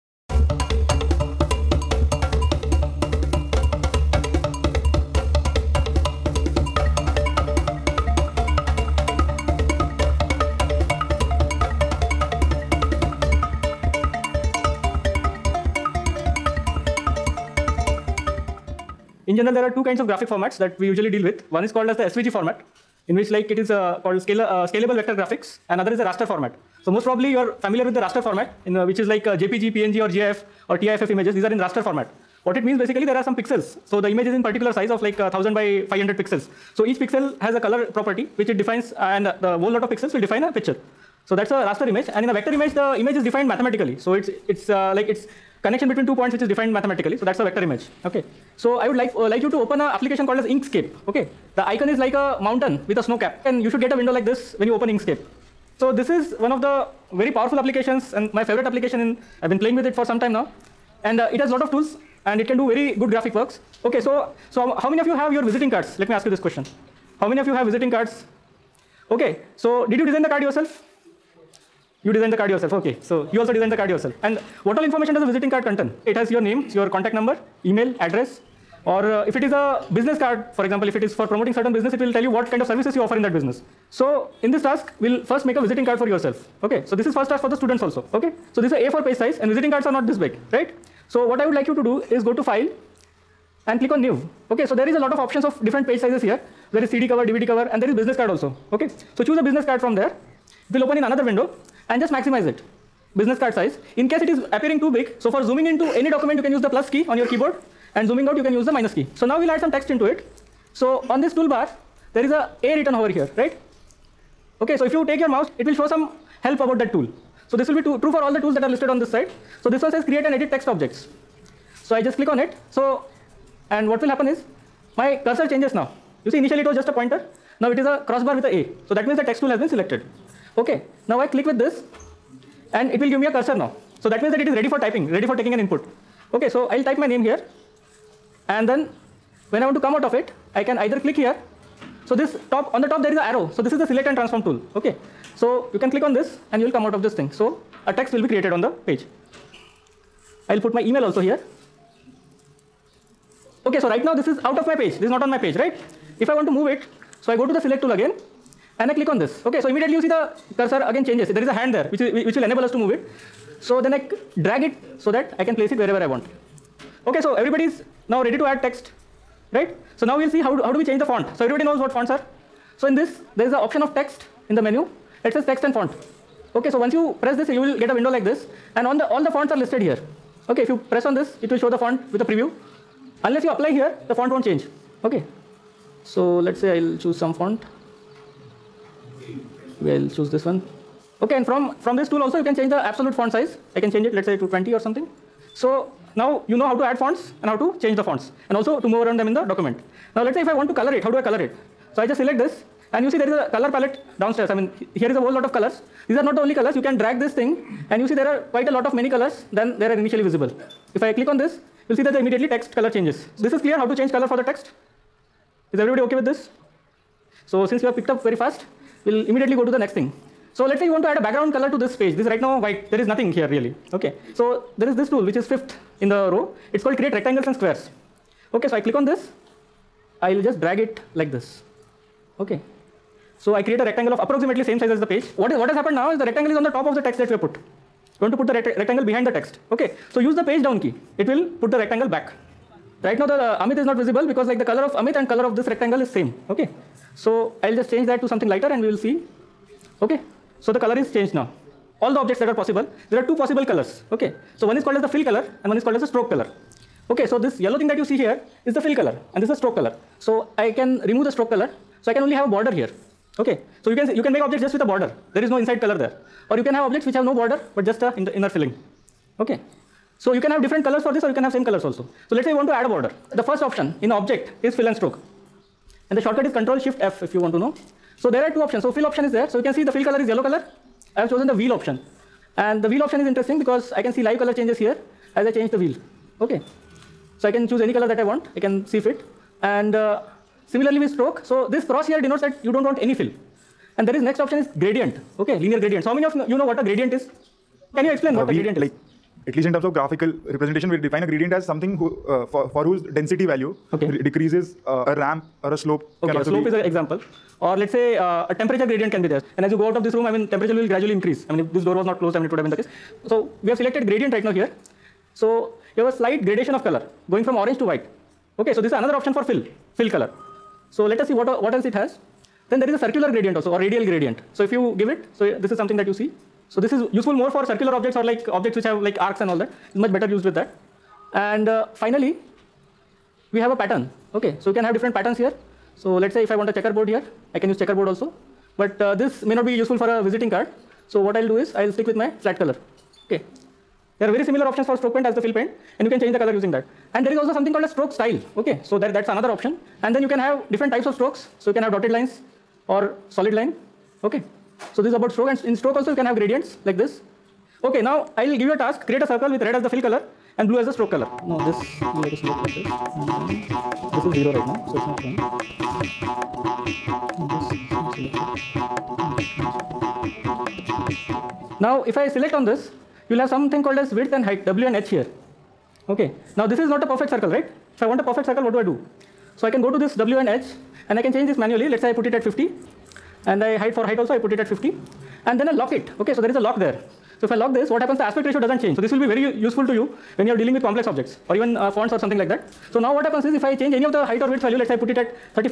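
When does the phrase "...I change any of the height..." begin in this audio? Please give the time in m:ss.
6:33.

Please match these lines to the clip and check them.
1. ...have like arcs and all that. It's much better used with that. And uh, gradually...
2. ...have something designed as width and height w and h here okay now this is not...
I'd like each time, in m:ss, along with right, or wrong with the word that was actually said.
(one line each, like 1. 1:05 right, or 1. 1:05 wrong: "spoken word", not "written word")
1. 5:28 wrong: "finally", not "gradually"
2. 6:13 wrong: "called", not "designed".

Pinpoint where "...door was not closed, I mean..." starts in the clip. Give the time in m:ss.
5:11.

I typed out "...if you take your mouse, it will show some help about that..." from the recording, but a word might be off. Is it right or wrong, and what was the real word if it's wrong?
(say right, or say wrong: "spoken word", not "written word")
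right.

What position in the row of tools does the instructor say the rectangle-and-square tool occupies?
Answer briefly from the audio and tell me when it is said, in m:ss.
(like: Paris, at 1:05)
Fifth, at 3:45.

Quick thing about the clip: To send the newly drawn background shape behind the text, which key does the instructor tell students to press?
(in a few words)
Page down.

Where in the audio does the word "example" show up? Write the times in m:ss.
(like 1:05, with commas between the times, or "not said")
1:20, 5:06.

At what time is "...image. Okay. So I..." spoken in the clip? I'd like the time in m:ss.
0:47.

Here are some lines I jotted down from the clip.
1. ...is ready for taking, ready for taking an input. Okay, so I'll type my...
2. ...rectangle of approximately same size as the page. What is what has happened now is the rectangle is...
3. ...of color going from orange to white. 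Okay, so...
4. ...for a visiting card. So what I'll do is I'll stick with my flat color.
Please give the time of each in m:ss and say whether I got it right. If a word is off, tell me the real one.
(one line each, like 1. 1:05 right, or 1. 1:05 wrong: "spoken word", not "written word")
1. 2:14 wrong: "typing", not "taking"
2. 3:53 right
3. 5:16 right
4. 5:39 right.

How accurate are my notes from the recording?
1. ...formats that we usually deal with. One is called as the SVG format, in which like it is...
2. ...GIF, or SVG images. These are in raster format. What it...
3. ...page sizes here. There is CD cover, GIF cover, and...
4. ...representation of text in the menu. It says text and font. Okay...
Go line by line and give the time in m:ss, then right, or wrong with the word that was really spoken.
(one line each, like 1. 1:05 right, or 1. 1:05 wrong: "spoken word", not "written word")
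1. 0:20 right
2. 0:30 wrong: "TIFF", not "SVG"
3. 1:35 wrong: "DVD", not "GIF"
4. 2:53 wrong: "option", not "representation".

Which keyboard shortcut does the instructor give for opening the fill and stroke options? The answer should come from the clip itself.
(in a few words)
Control Shift F.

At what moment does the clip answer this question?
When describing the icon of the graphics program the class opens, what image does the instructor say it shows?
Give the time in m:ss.
0:52.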